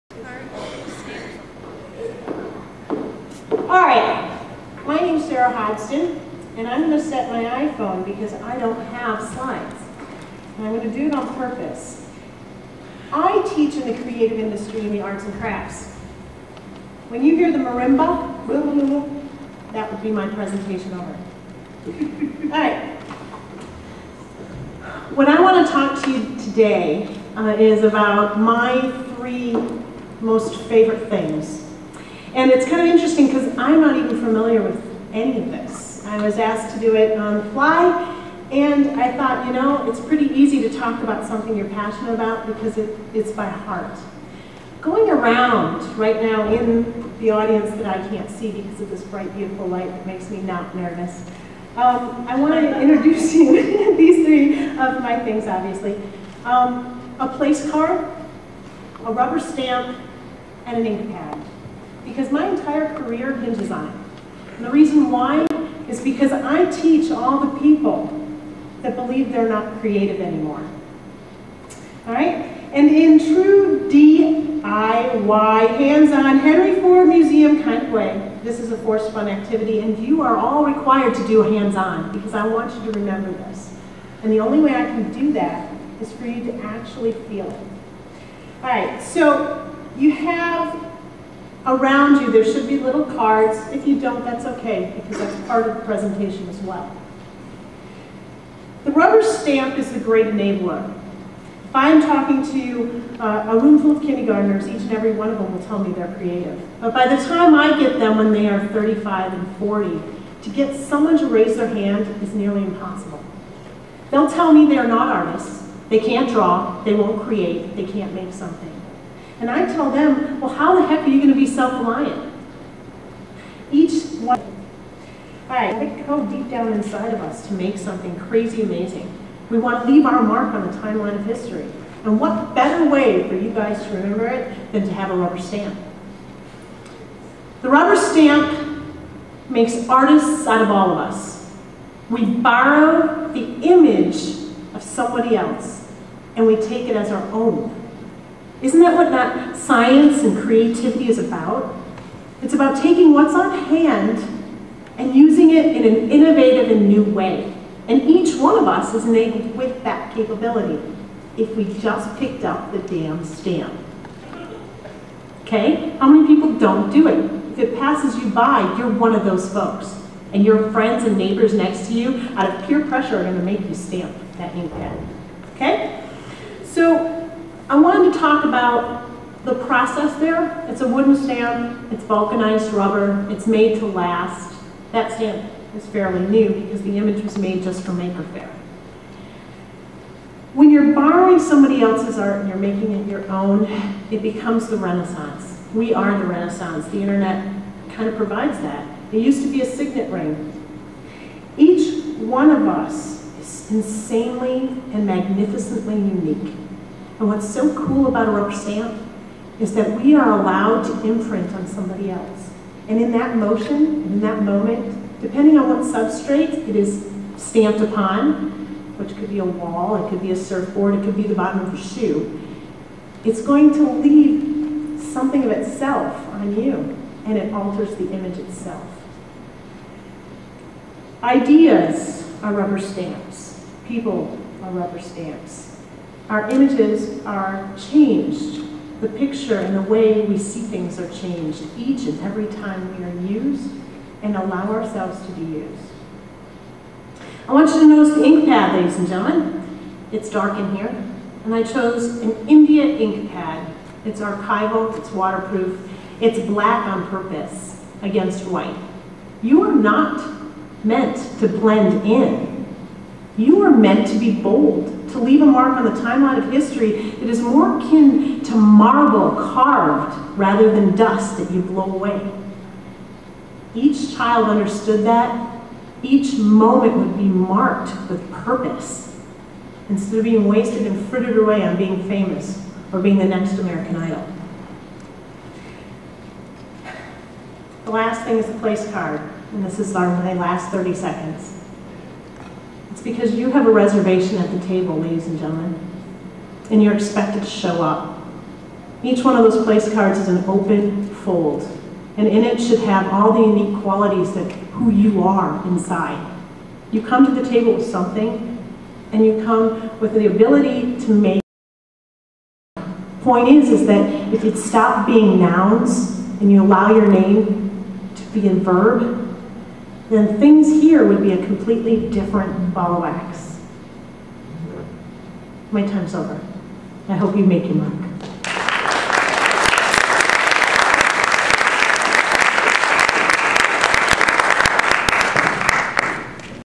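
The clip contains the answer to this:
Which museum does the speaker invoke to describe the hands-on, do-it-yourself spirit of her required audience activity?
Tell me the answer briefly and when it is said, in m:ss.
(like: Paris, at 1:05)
Henry Ford Museum, at 1:16.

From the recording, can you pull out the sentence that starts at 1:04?
And the reason why is because I teach all the people that believe they're not creative anymore.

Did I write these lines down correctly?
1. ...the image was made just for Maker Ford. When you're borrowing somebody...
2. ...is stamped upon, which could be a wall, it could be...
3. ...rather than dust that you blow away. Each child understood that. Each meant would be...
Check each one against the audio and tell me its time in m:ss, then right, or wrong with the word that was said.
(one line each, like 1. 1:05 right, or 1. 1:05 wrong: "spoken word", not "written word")
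1. 3:06 wrong: "Faire", not "Ford"
2. 3:36 right
3. 4:30 wrong: "moment", not "meant".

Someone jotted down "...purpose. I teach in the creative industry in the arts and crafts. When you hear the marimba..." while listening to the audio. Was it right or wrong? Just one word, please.
right.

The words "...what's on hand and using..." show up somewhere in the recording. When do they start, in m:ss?
2:33.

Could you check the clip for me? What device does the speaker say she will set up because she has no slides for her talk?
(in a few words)
iPhone.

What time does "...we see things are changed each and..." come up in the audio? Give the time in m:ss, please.
4:00.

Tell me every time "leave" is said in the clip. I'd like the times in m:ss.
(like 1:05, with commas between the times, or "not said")
2:09, 3:43, 4:25.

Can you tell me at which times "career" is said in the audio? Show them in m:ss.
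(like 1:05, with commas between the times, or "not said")
1:02.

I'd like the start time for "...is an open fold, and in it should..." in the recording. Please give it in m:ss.
5:00.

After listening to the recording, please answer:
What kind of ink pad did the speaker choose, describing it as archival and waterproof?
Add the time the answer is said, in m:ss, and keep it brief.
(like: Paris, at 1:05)
India ink, at 4:12.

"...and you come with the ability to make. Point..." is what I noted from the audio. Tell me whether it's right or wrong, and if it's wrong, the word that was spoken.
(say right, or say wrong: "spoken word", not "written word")
right.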